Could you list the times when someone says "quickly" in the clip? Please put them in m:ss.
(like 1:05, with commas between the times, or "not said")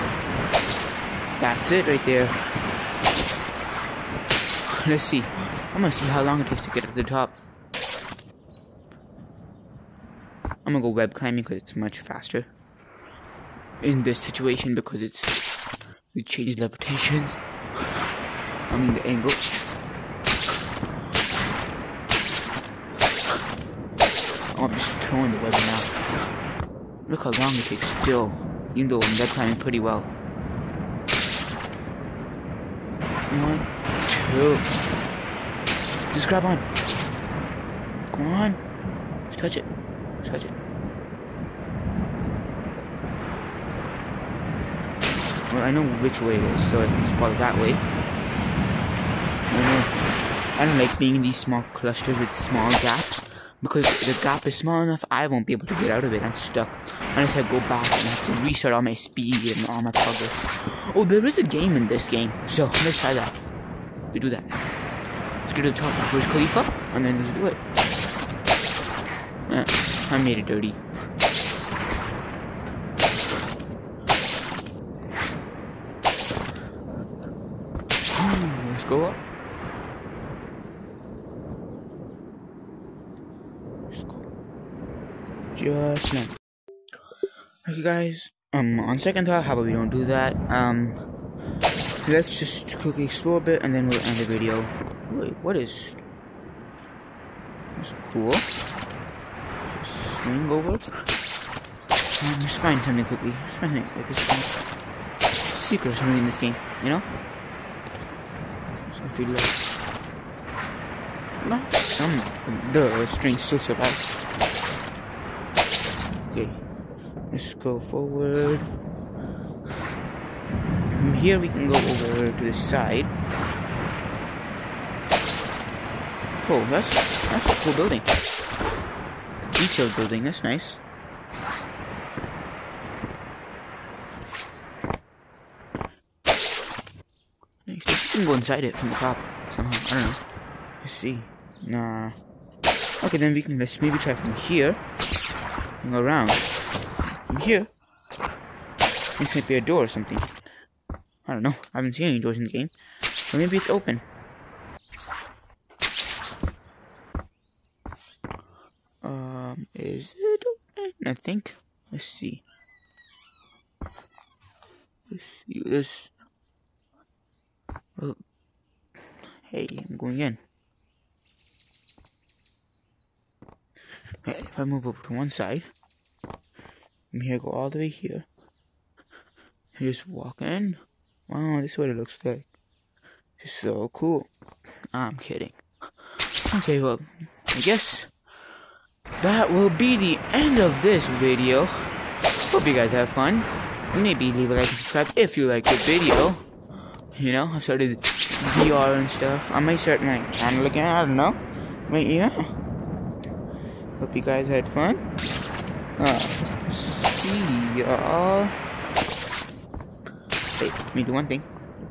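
1:32, 1:43.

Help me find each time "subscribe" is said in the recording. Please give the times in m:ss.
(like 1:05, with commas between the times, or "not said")
3:14.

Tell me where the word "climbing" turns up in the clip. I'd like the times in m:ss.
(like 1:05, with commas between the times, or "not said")
0:11, 0:29.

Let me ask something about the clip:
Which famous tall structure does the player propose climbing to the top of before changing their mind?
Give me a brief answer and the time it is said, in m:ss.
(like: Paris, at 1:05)
Khalifa, at 1:06.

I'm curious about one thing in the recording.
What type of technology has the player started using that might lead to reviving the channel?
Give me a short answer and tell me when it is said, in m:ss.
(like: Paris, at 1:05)
VR, at 3:18.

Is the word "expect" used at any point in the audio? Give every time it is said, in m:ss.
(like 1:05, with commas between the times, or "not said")
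not said.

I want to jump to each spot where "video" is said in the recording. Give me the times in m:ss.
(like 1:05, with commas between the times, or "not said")
1:34, 3:11, 3:15.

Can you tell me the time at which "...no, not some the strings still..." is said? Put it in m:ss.
1:51.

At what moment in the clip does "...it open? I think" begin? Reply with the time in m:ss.
2:40.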